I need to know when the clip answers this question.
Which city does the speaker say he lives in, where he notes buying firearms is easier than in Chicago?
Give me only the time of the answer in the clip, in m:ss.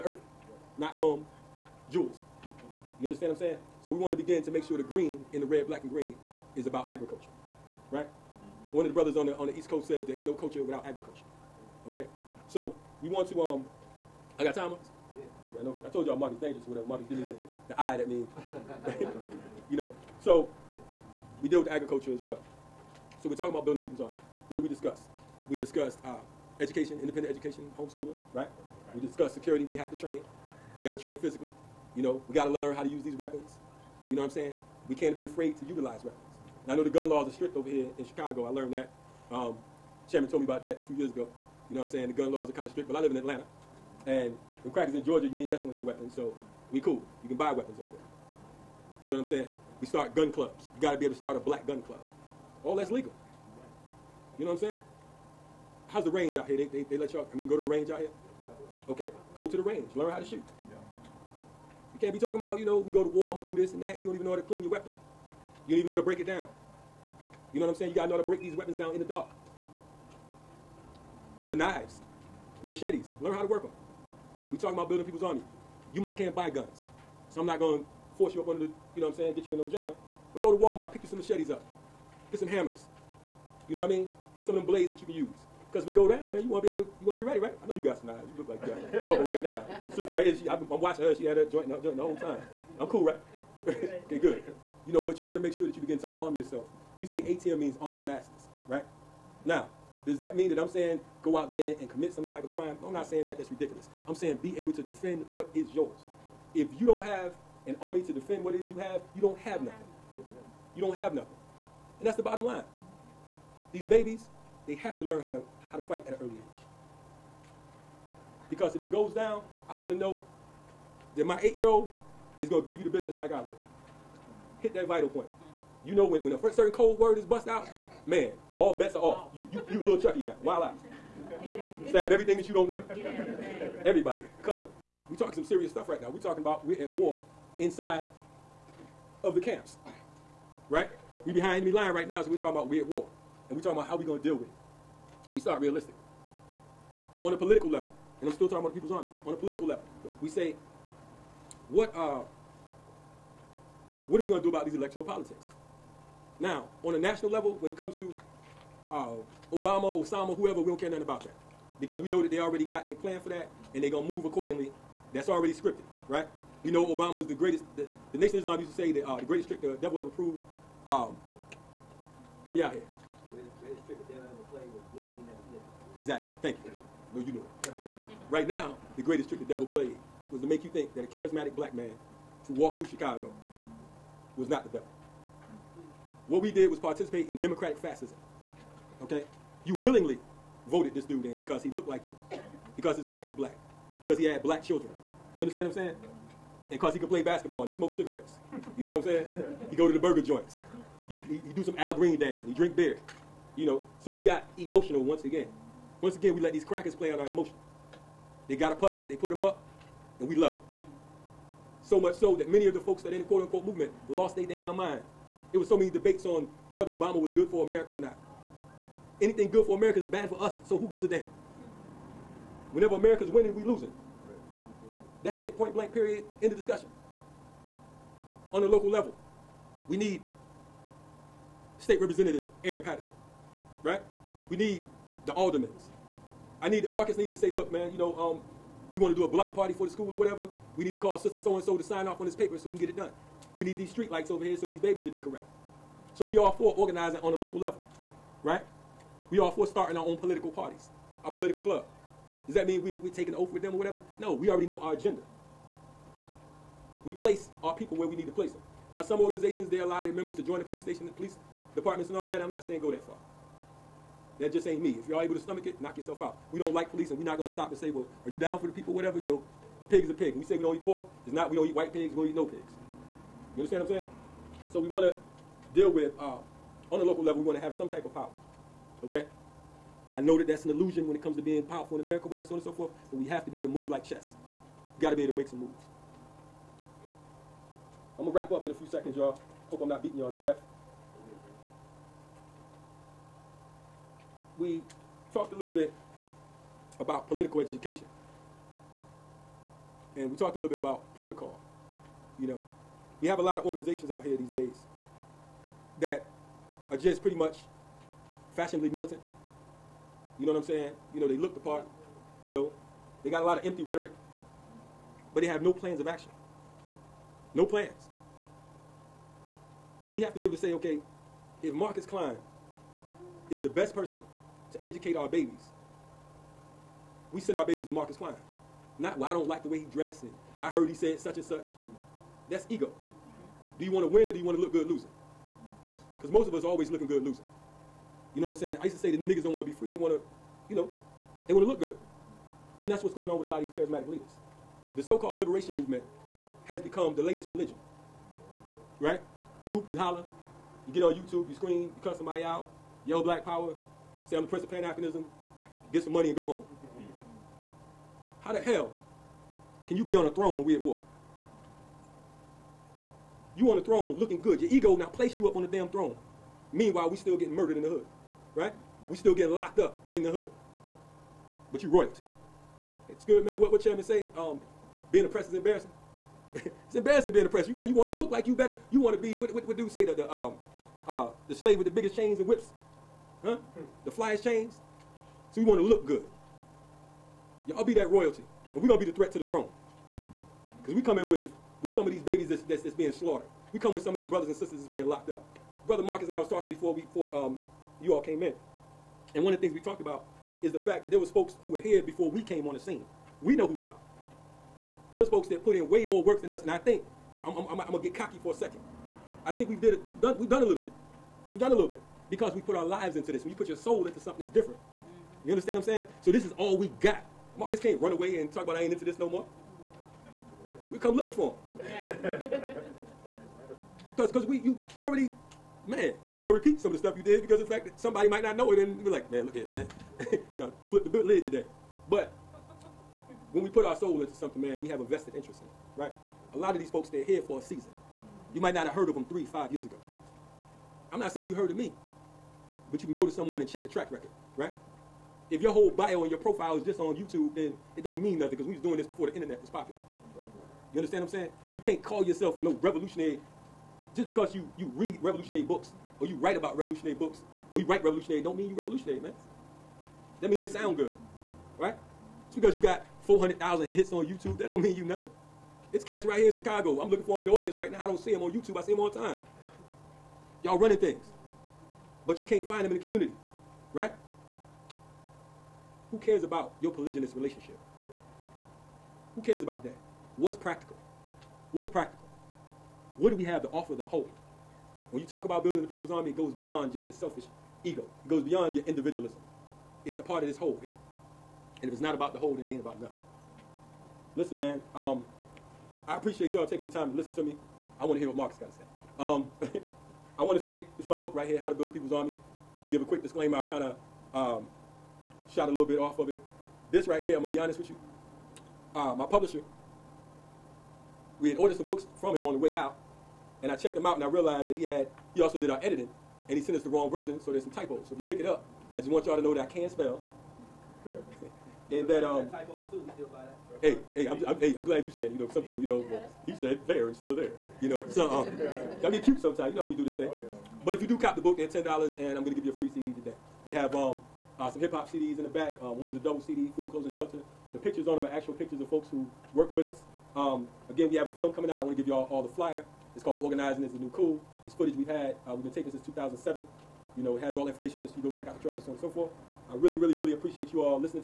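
0:43.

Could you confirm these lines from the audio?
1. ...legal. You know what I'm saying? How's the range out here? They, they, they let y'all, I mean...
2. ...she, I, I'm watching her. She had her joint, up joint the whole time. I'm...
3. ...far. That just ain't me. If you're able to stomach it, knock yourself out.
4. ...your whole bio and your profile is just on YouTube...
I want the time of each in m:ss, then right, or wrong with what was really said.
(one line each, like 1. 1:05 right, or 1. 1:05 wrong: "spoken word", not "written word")
1. 0:52 right
2. 1:30 right
3. 4:23 right
4. 7:25 right.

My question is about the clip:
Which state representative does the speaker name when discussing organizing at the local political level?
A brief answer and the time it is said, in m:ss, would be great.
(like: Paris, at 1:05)
Aaron Patterson, at 3:52.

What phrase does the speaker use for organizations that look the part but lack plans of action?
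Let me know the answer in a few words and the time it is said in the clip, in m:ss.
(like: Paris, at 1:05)
fashionably militant, at 5:08.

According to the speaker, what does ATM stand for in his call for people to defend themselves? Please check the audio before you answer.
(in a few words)
arm the masses.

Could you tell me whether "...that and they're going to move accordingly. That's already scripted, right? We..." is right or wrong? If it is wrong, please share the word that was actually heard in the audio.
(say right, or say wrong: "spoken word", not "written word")
right.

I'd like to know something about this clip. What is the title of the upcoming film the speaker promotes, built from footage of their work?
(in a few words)
Organizing is the New Cool.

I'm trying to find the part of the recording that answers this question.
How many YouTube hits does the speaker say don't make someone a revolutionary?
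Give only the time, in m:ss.
7:43.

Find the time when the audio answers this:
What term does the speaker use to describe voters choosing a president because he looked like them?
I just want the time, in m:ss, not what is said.
3:07.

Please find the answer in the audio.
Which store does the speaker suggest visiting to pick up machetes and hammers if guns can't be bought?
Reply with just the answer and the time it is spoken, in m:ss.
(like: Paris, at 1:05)
Walmart, at 1:20.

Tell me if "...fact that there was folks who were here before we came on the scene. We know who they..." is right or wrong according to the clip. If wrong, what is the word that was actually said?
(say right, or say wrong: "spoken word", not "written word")
right.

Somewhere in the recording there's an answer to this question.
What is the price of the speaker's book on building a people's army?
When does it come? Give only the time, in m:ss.
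8:51.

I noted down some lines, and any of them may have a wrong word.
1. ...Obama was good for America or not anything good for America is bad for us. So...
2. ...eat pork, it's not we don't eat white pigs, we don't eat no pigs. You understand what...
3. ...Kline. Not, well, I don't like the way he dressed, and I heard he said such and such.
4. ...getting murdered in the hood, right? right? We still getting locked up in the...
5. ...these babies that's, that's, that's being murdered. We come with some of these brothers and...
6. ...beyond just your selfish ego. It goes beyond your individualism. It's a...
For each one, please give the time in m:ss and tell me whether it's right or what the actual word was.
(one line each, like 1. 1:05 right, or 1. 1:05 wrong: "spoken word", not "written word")
1. 3:36 right
2. 4:30 right
3. 5:28 right
4. 6:07 right
5. 6:32 wrong: "slaughtered", not "murdered"
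6. 8:06 right.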